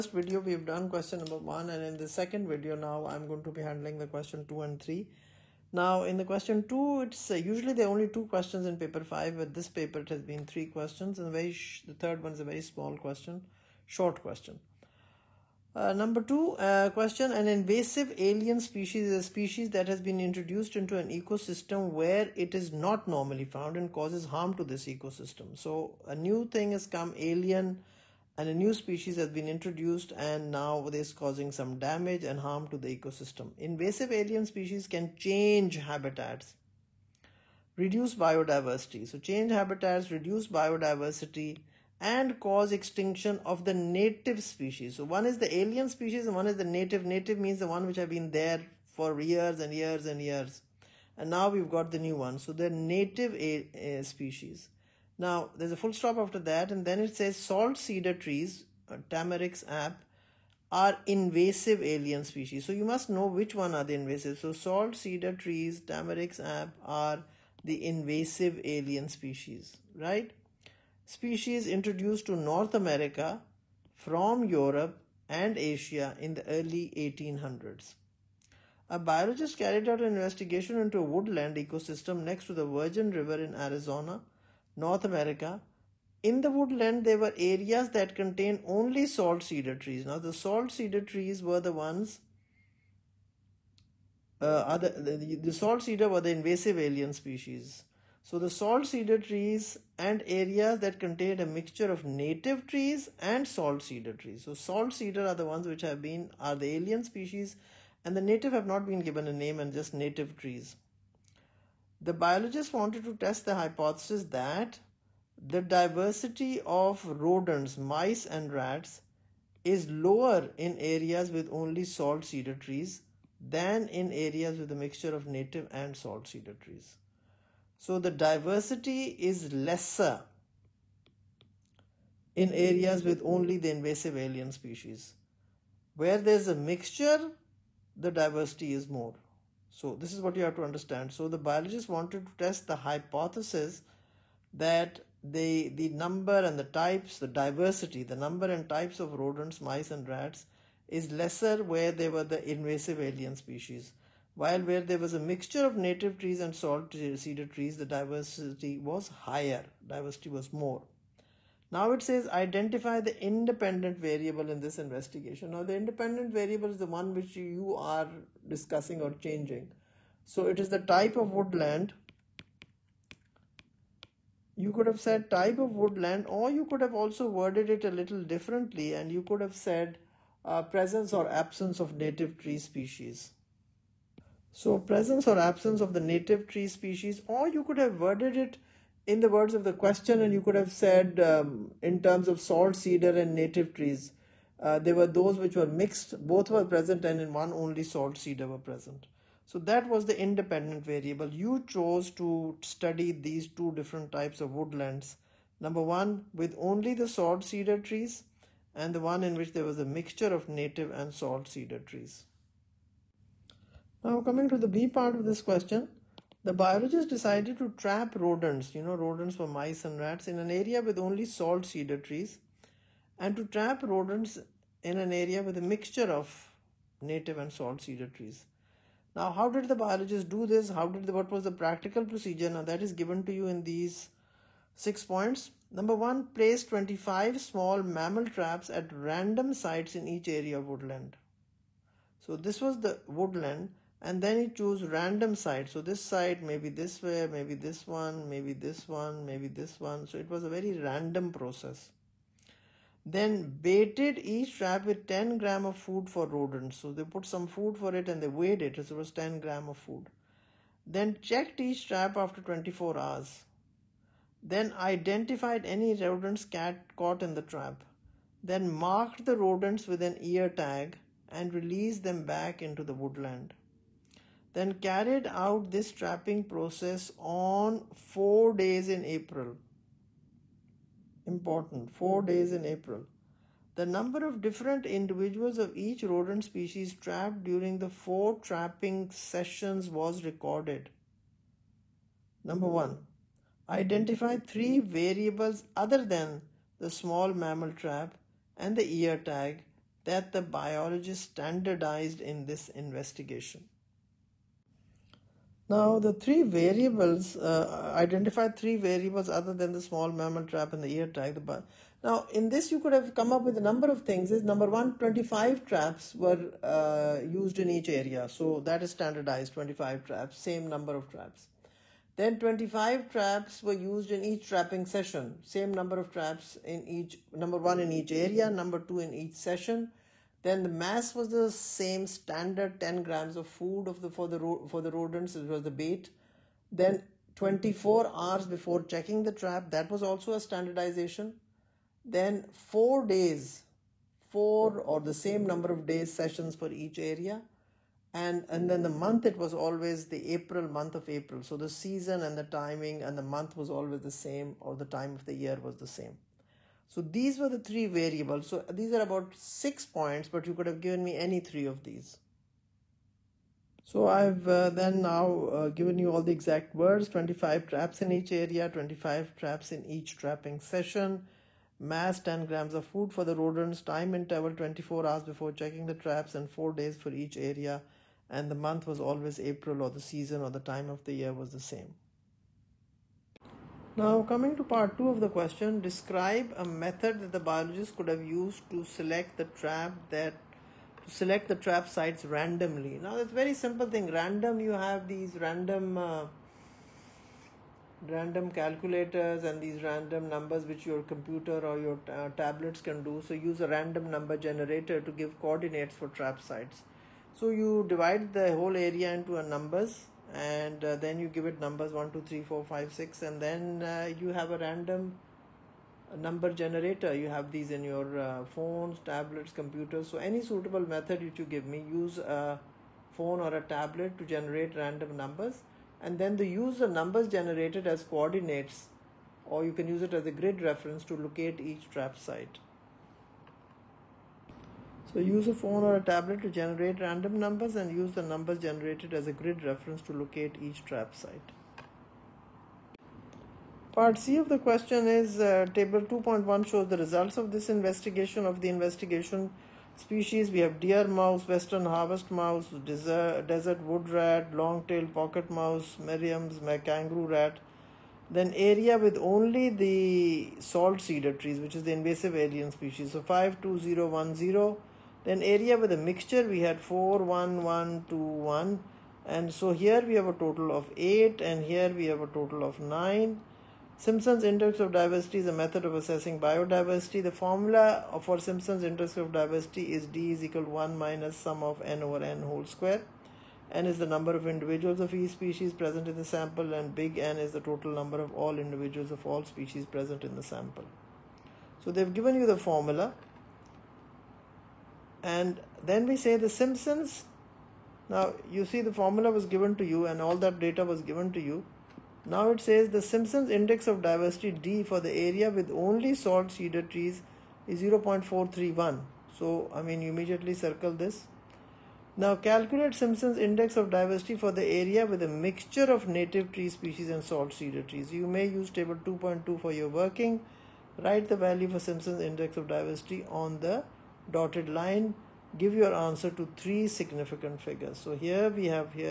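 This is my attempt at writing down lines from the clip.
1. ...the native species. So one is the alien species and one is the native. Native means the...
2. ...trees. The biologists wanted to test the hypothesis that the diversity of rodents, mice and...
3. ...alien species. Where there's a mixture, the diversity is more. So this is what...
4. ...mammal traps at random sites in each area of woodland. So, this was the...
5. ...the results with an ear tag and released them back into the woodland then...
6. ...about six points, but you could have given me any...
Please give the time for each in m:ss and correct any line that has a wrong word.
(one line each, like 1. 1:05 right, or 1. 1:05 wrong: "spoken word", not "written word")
1. 0:43 right
2. 1:50 right
3. 2:14 right
4. 3:57 right
5. 4:29 wrong: "rodents", not "results"
6. 5:59 right.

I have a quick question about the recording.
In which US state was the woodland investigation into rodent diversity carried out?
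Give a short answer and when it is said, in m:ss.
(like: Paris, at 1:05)
Arizona, at 1:23.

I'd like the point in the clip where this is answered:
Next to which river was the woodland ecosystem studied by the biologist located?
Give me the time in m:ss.
1:22.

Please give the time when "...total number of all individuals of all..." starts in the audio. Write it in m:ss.
8:07.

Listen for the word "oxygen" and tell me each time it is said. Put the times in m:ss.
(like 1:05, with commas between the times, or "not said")
not said.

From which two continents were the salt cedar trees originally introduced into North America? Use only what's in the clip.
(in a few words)
Europe and Asia.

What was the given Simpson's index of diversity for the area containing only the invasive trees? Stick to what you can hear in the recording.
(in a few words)
0.431.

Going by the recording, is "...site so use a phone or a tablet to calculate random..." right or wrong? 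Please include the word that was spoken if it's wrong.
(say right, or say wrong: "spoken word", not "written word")
wrong: "generate", not "calculate".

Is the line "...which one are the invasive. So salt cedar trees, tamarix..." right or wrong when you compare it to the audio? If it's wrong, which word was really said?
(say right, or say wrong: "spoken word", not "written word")
right.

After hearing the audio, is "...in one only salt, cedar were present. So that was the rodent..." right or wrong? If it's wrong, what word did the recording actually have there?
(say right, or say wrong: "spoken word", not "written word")
wrong: "independent", not "rodent".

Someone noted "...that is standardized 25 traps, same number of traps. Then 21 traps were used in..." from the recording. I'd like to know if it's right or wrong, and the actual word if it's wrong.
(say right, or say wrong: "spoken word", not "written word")
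wrong: "25", not "21".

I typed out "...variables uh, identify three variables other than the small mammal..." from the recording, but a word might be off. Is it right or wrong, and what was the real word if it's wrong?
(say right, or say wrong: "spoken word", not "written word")
right.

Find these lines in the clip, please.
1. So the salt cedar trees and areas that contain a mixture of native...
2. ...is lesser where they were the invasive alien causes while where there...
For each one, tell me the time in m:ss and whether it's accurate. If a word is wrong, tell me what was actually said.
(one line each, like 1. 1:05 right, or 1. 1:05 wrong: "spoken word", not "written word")
1. 1:38 right
2. 2:30 wrong: "species", not "causes".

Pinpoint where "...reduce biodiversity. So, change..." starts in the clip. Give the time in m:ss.
0:37.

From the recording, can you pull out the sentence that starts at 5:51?
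So the season and the timing and the month was always the same, or the time of the year was the same.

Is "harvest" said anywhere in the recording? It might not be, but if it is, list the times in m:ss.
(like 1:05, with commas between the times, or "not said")
7:31.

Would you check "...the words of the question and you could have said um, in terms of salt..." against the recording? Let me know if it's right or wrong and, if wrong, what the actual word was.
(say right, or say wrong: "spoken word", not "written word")
right.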